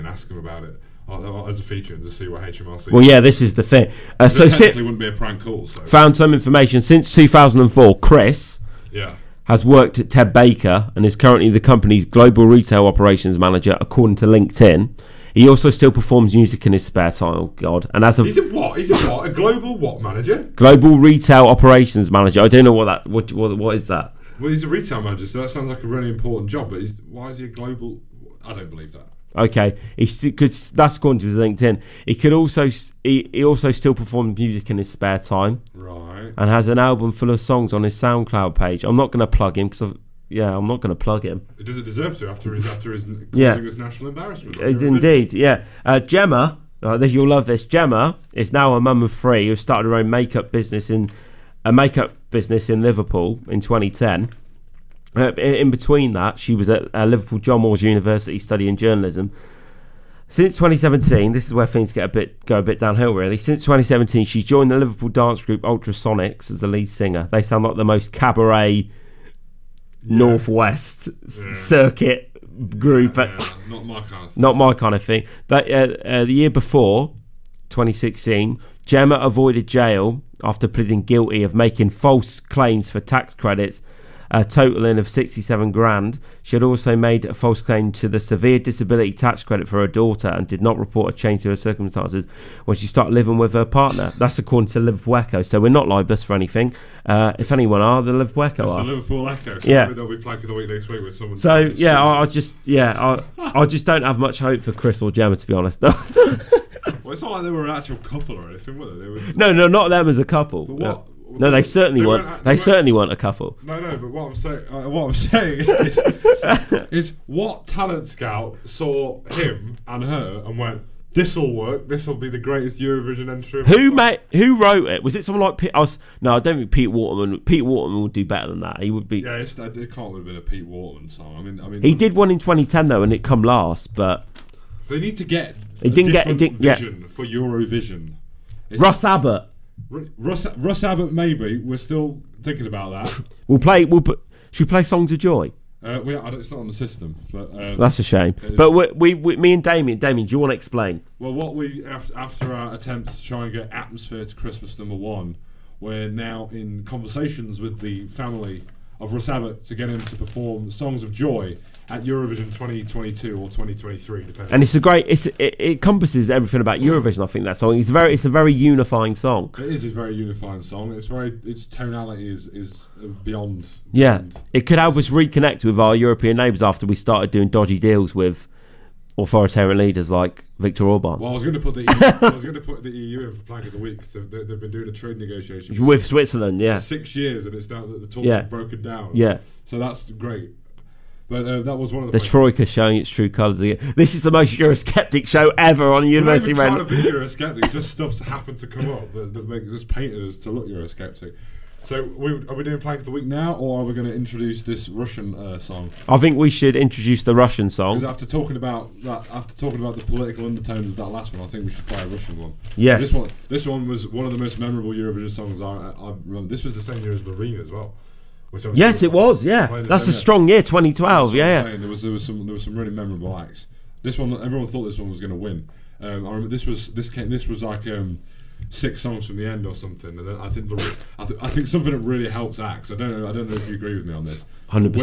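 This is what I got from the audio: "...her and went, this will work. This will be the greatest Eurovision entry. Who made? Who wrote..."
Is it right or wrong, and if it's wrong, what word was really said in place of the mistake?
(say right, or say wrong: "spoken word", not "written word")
right.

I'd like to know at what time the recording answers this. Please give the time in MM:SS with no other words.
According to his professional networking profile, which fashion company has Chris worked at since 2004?
00:10.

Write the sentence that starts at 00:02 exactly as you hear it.
Well, yeah, this is the thing.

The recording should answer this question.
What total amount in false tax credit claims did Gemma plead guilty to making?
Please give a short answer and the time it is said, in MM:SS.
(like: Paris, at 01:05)
67 grand, at 01:25.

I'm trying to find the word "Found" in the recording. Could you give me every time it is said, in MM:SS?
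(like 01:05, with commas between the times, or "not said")
00:05.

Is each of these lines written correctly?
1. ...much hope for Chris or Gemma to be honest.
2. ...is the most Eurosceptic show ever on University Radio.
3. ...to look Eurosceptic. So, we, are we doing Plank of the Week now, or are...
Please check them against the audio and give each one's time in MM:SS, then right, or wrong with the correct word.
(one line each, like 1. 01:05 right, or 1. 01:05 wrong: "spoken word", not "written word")
1. 01:44 right
2. 03:14 right
3. 03:20 right.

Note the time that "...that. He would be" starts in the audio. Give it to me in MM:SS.
02:08.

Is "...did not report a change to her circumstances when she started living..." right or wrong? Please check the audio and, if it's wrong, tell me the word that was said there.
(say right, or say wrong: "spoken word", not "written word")
right.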